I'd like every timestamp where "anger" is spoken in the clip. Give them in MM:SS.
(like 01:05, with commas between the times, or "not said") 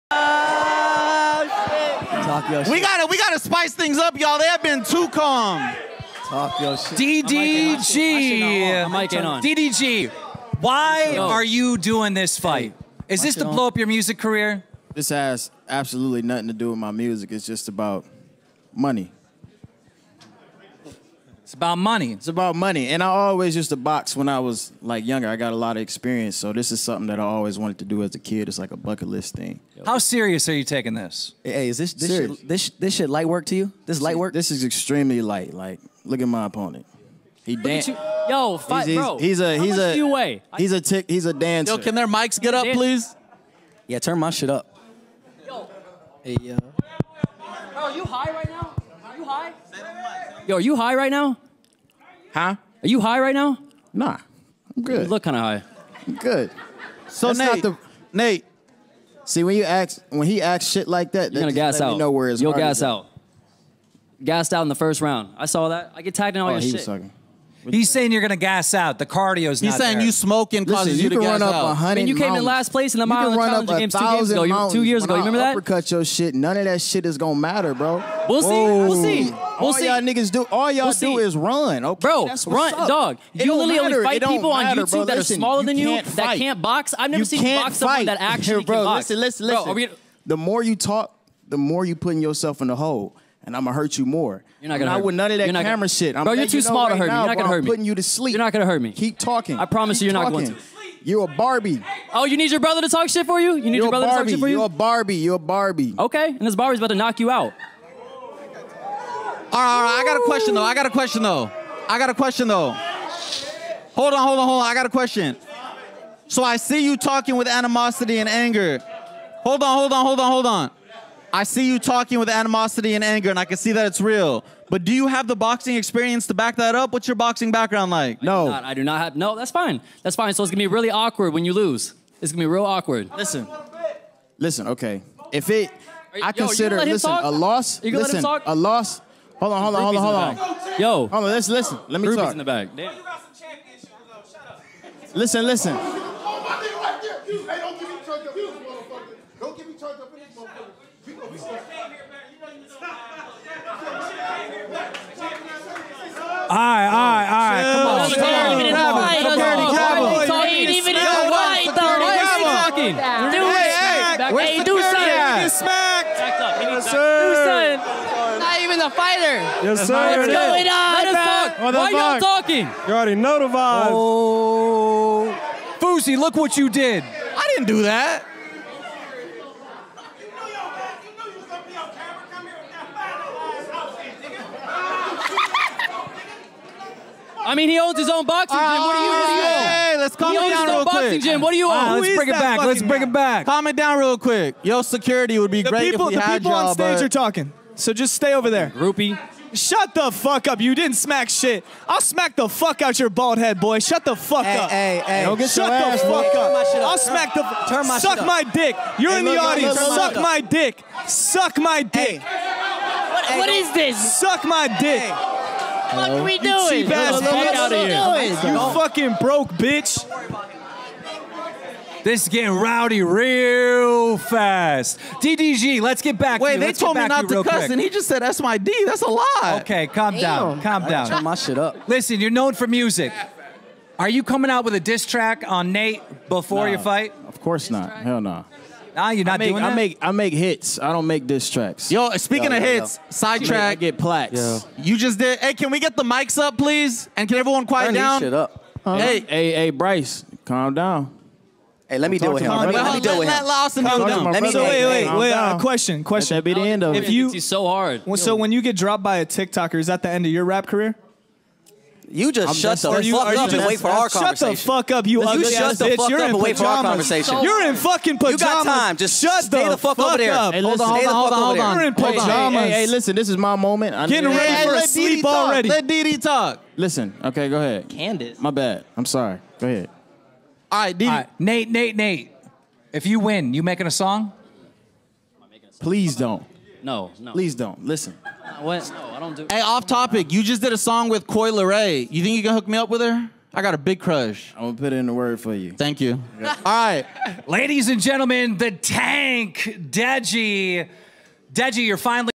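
01:58, 02:03.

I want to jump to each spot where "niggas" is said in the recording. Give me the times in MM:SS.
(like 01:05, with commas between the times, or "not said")
01:20.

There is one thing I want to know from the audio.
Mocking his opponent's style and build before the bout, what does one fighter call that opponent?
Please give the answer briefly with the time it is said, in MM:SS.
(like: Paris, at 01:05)
dancer, at 00:41.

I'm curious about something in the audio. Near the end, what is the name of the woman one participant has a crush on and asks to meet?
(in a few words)
Koi Ray.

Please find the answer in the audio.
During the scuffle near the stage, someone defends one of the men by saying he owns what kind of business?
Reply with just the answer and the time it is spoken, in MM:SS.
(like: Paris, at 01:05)
boxing gym, at 03:08.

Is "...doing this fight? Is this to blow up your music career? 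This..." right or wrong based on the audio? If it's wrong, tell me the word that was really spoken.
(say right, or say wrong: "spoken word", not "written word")
right.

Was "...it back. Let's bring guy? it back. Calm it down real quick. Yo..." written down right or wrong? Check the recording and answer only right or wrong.
right.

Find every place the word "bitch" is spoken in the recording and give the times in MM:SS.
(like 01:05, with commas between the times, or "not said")
03:39, 04:25.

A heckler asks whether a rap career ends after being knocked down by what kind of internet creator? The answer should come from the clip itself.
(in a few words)
TikToker.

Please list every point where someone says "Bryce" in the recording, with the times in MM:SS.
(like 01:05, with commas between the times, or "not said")
04:09.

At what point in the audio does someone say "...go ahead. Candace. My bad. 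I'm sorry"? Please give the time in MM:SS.
04:37.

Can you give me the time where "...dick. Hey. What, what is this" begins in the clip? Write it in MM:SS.
03:31.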